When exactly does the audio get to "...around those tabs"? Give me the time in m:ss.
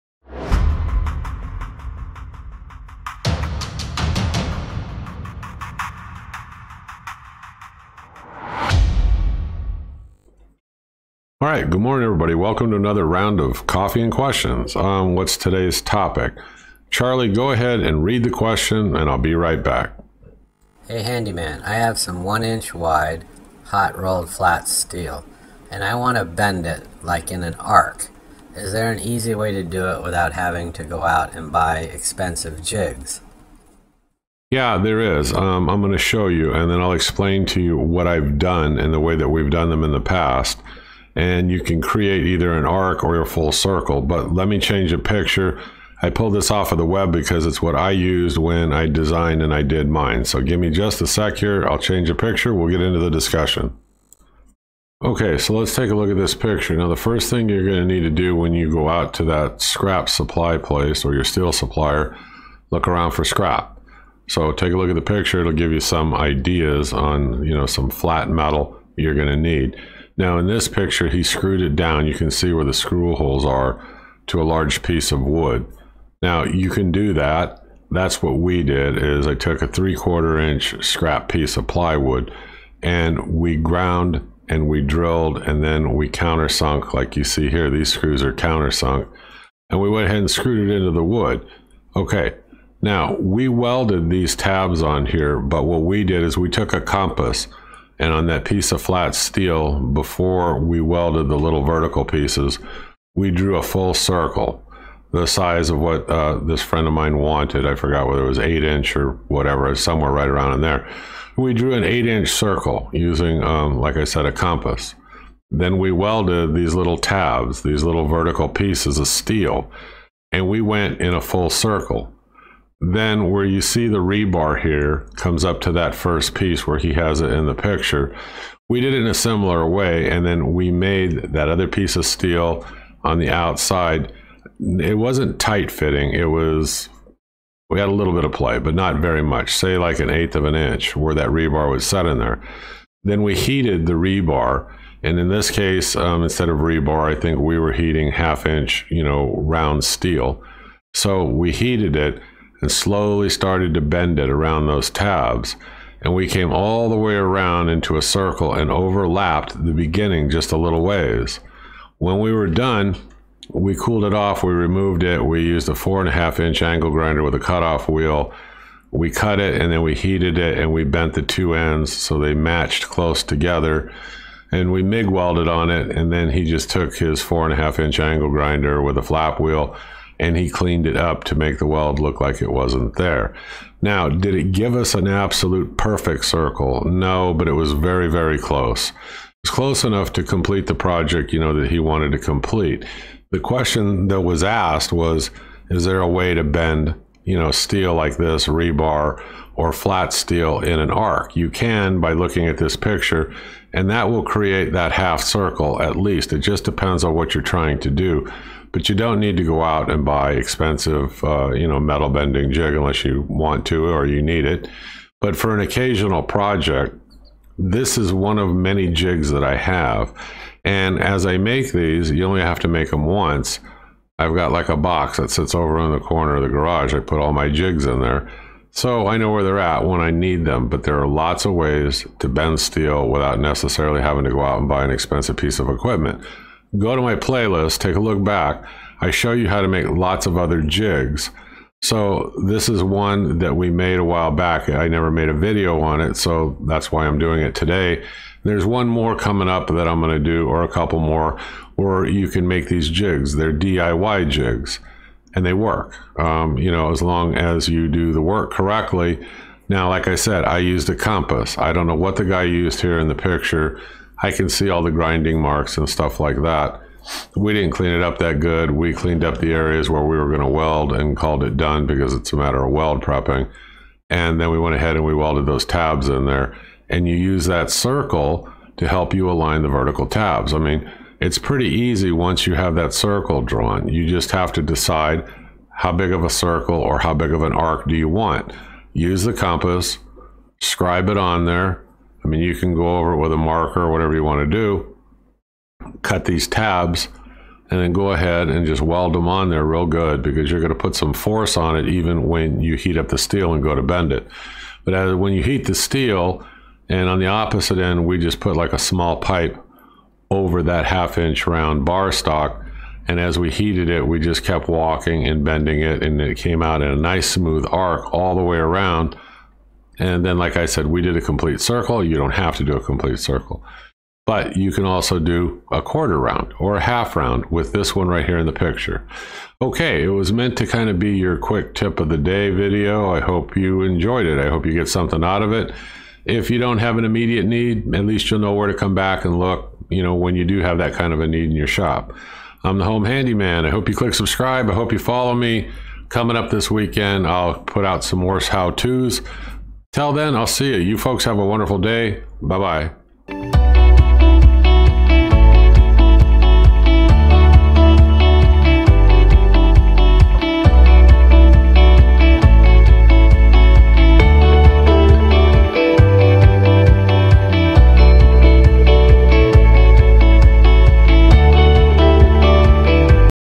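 2:34.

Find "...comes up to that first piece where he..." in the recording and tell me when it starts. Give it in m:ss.
2:05.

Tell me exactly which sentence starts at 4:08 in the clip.
There's one more coming up that I'm gonna do, or a couple more, where you can make these jigs.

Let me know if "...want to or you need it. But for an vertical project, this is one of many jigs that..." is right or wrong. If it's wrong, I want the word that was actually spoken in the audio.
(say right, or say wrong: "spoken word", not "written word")
wrong: "occasional", not "vertical".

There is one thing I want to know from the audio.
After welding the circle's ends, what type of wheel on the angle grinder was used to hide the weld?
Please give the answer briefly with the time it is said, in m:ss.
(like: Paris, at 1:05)
flap wheel, at 2:59.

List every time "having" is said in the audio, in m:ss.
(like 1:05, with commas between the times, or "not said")
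0:30, 3:54.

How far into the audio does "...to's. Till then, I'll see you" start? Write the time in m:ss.
5:48.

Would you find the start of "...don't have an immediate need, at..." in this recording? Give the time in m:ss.
5:36.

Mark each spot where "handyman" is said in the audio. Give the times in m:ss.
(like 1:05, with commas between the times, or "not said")
0:21, 5:43.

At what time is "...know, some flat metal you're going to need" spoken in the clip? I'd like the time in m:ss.
1:07.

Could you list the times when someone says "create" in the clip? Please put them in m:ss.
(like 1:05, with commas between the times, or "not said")
0:41, 3:24.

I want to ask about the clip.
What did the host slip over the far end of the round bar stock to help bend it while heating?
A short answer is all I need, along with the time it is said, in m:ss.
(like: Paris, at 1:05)
small pipe, at 5:08.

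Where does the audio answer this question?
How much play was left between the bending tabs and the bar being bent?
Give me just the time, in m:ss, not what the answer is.
2:19.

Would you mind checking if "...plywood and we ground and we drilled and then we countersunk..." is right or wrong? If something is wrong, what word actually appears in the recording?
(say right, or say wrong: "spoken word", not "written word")
right.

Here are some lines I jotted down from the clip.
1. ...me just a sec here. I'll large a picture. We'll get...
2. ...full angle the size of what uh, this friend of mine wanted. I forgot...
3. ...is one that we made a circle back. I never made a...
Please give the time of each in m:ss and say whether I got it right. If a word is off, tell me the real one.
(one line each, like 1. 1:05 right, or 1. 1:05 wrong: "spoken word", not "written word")
1. 0:50 wrong: "change", not "large"
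2. 1:43 wrong: "circle", not "angle"
3. 4:02 wrong: "while", not "circle".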